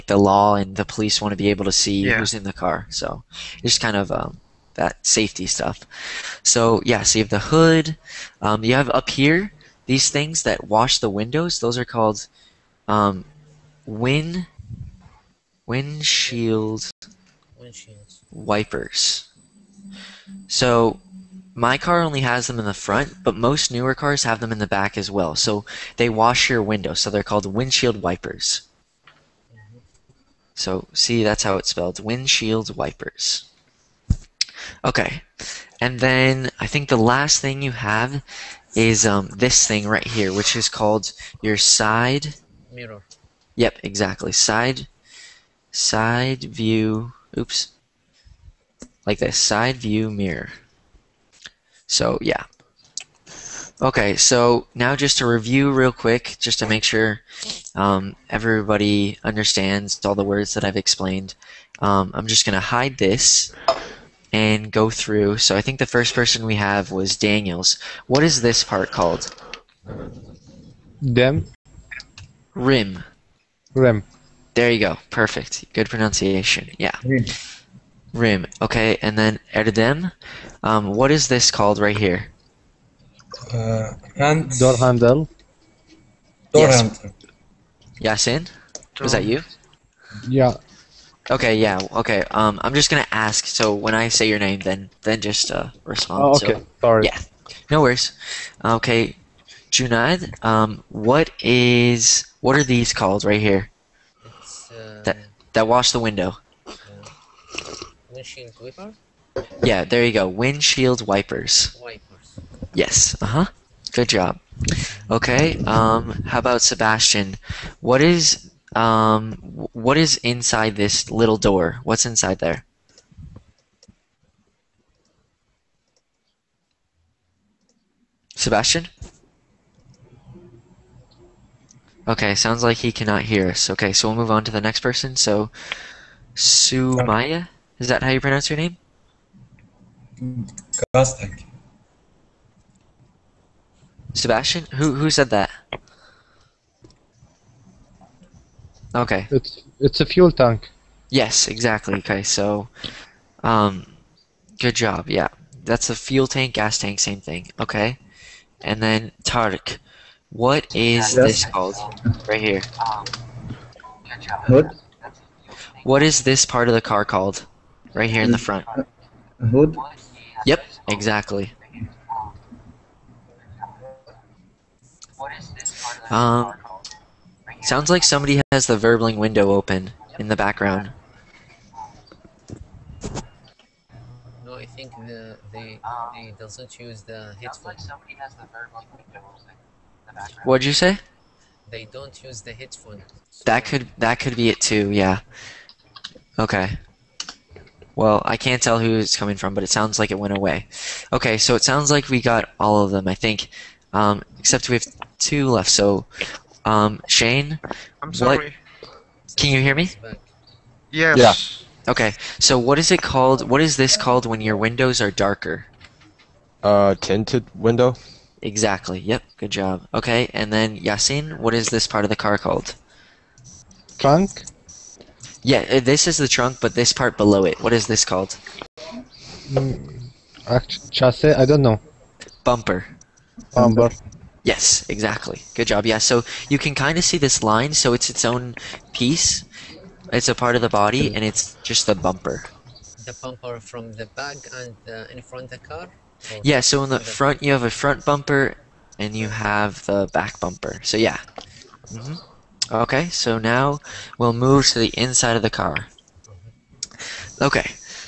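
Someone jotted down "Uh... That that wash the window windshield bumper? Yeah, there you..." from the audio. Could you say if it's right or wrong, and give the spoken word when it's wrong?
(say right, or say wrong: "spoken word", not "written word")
wrong: "wiper", not "bumper".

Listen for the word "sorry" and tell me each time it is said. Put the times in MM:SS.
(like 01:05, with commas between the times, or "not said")
01:36, 03:28.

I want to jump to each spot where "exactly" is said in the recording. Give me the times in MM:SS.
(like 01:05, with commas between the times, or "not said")
00:43, 02:31, 02:50, 03:38, 03:54.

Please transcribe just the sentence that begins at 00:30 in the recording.
So see, that's how it's spelled, windshield wipers.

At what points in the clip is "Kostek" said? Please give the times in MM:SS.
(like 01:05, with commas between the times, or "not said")
02:20.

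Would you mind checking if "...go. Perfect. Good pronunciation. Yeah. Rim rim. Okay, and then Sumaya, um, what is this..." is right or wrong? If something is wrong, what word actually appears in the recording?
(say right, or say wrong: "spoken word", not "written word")
wrong: "Erdem", not "Sumaya".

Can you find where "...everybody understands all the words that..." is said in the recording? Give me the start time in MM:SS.
00:58.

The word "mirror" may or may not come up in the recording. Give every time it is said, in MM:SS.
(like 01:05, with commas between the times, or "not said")
00:42, 00:50.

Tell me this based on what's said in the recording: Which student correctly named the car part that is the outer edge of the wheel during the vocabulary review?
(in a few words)
Daniels.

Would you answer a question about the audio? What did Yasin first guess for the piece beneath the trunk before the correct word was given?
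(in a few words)
chassis.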